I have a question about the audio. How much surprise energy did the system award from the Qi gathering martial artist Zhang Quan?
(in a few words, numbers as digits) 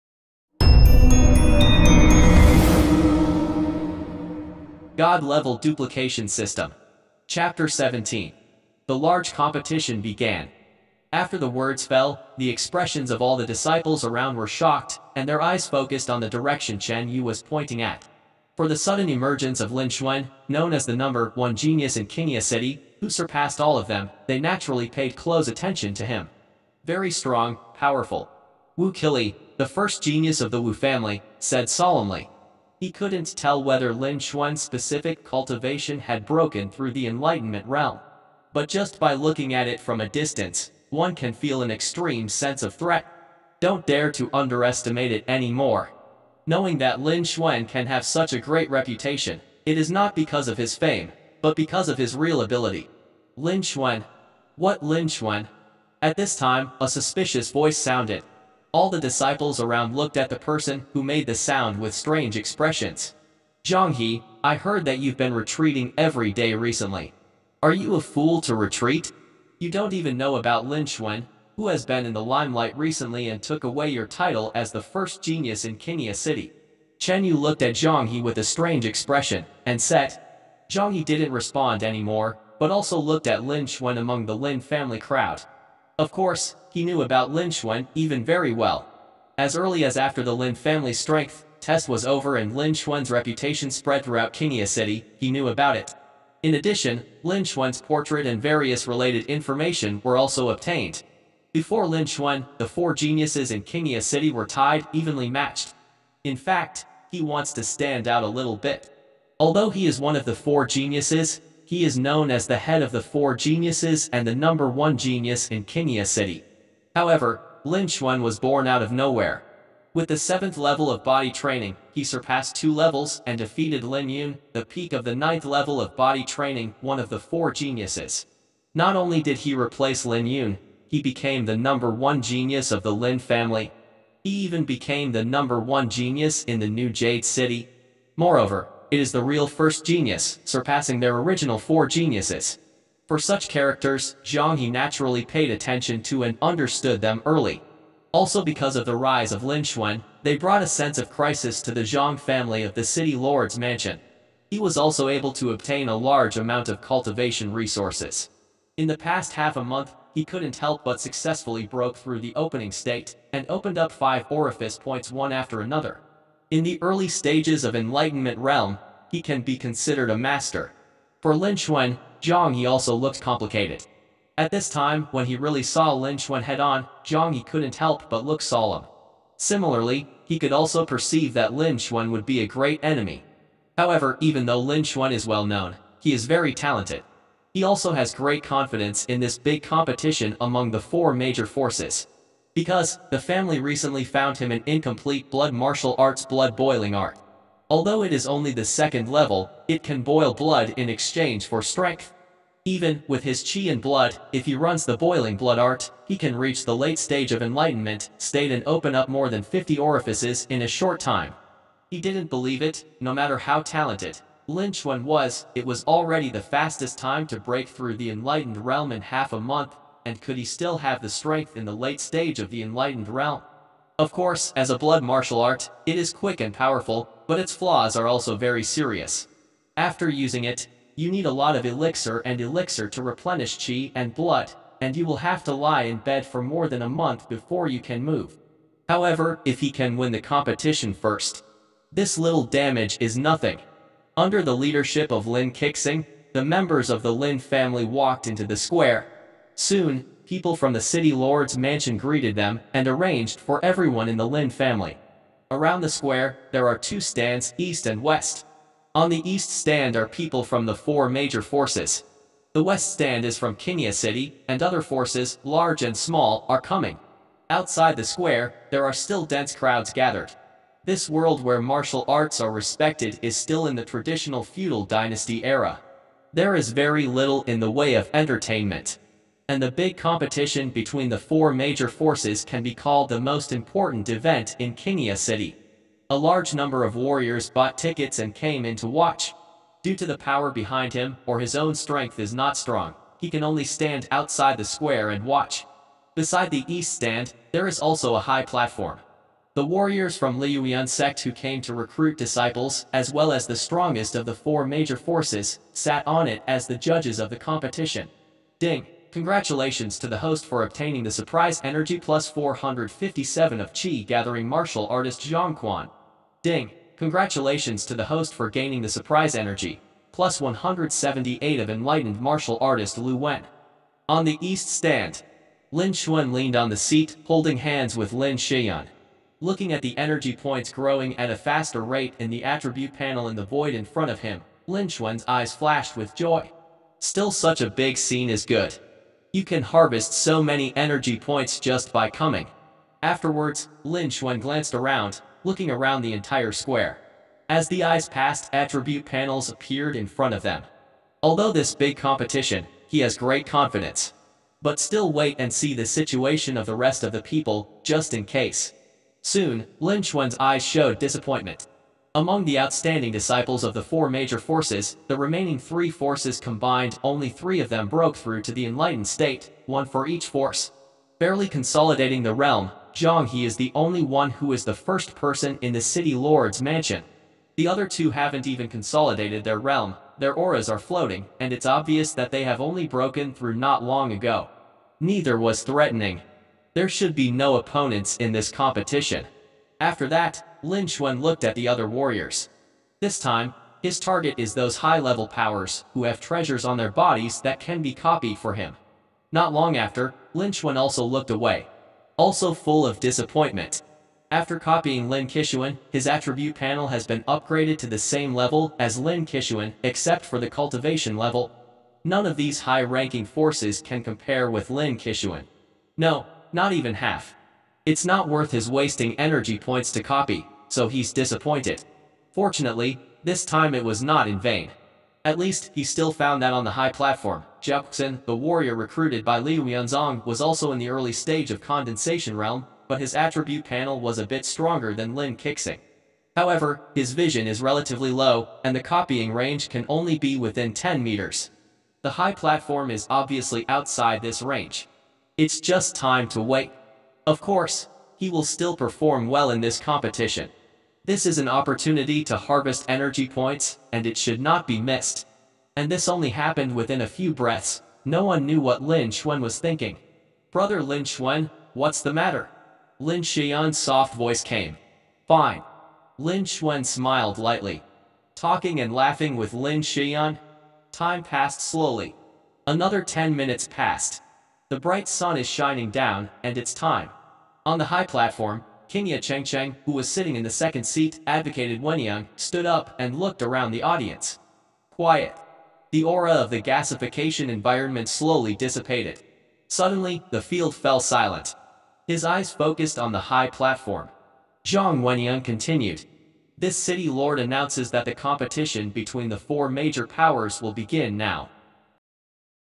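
457.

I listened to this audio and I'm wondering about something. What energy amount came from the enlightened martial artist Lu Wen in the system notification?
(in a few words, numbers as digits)
178.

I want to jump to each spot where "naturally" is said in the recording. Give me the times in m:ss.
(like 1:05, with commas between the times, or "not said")
0:24, 2:24.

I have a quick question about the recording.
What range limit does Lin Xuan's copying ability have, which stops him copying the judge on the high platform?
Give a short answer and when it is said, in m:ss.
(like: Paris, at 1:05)
10 meters, at 7:20.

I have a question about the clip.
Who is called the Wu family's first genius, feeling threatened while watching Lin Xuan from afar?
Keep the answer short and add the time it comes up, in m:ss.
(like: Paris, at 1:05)
Wu Qili, at 0:28.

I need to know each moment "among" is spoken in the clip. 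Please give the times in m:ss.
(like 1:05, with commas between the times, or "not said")
1:23, 3:10, 6:02.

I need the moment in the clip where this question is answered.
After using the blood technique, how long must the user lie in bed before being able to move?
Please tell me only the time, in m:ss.
3:56.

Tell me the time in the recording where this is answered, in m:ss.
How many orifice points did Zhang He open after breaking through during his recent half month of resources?
2:43.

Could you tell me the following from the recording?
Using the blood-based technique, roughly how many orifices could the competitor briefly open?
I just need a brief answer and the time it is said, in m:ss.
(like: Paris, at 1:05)
more than 50, at 3:29.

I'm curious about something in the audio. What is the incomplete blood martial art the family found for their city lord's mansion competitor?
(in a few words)
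blood boiling art.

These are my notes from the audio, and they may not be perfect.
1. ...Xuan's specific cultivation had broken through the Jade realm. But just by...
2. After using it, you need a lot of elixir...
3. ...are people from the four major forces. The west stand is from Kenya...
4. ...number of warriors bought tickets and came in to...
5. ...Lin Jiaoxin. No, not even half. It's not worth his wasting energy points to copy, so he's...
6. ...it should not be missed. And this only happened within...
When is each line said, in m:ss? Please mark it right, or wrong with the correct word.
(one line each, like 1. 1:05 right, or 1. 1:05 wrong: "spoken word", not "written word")
1. 0:34 wrong: "Enlightenment", not "Jade"
2. 3:49 right
3. 4:19 right
4. 4:46 right
5. 6:54 wrong: "Kishuan", not "Jiaoxin"
6. 7:34 right.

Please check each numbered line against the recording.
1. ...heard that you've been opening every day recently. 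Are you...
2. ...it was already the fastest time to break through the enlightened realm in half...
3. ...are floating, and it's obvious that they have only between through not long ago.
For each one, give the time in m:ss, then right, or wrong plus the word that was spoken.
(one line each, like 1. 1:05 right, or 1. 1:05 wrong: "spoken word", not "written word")
1. 1:04 wrong: "retreating", not "opening"
2. 3:35 right
3. 6:20 wrong: "broken", not "between".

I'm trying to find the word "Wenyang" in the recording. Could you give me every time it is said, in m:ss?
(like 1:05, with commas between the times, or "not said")
8:01, 8:15.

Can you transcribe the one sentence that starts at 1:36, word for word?
In addition, Lin Xuan's portrait and various related information were also obtained.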